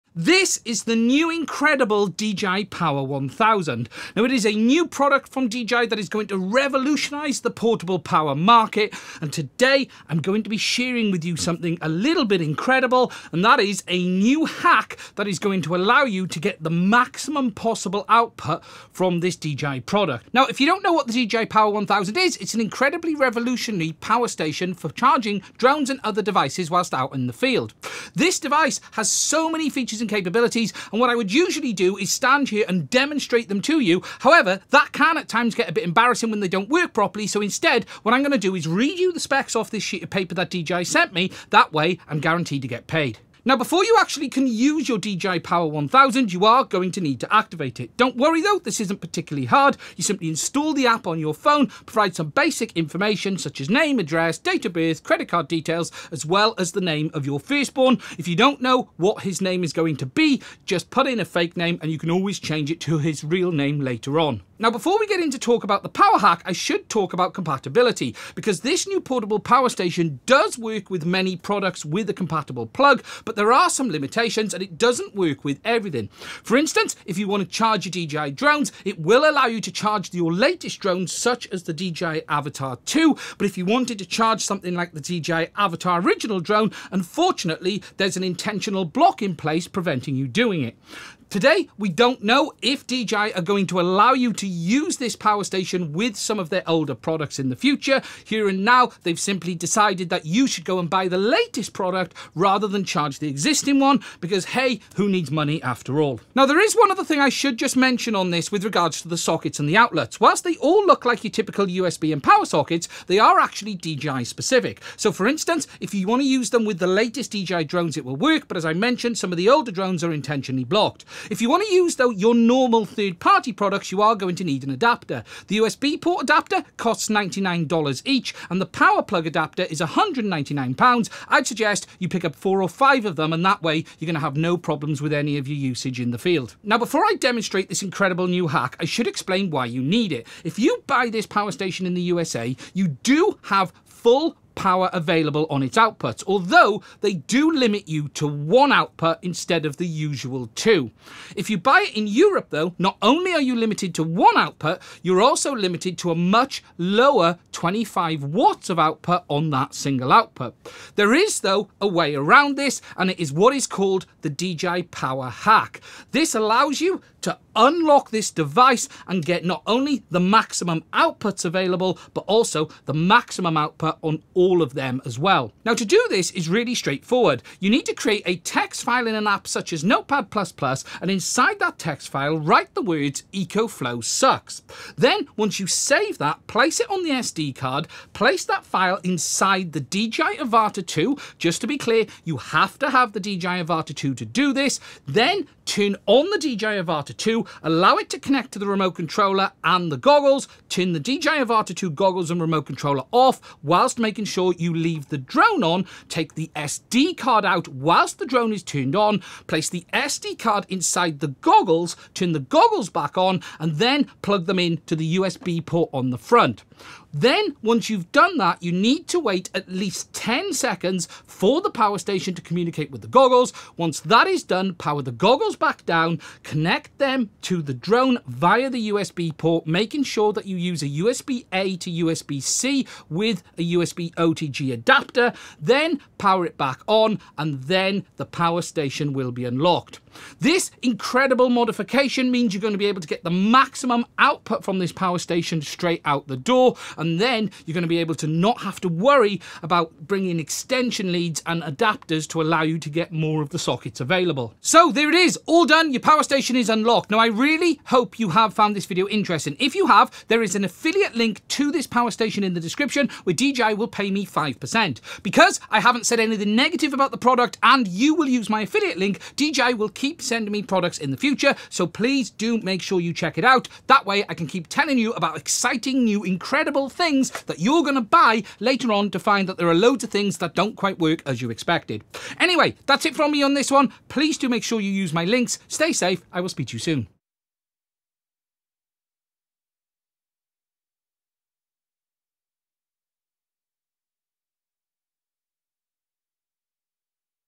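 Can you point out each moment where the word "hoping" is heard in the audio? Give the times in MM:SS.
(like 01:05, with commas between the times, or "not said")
not said.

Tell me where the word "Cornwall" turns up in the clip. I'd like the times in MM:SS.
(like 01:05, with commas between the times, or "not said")
not said.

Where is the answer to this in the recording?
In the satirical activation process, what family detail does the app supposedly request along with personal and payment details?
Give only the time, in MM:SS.
00:56.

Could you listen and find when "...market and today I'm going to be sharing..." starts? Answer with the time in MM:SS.
00:08.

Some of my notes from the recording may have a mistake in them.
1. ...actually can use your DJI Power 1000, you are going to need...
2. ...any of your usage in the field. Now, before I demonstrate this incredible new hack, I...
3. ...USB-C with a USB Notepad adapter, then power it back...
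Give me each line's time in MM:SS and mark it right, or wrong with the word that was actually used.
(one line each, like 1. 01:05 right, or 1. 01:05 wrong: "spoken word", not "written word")
1. 00:43 right
2. 02:15 right
3. 03:52 wrong: "OTG", not "Notepad".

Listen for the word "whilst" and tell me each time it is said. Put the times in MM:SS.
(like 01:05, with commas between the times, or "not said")
00:26, 01:50, 03:23, 03:27.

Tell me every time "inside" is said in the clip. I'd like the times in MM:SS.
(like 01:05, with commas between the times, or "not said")
03:01, 03:09, 03:30.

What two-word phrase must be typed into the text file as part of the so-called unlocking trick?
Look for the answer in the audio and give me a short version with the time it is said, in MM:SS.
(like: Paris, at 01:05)
EcoFlow sucks, at 03:03.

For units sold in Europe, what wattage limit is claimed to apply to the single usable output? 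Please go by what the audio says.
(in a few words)
25 watts.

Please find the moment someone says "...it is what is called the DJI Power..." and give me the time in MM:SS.
02:43.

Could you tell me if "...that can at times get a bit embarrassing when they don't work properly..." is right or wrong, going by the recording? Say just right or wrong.
right.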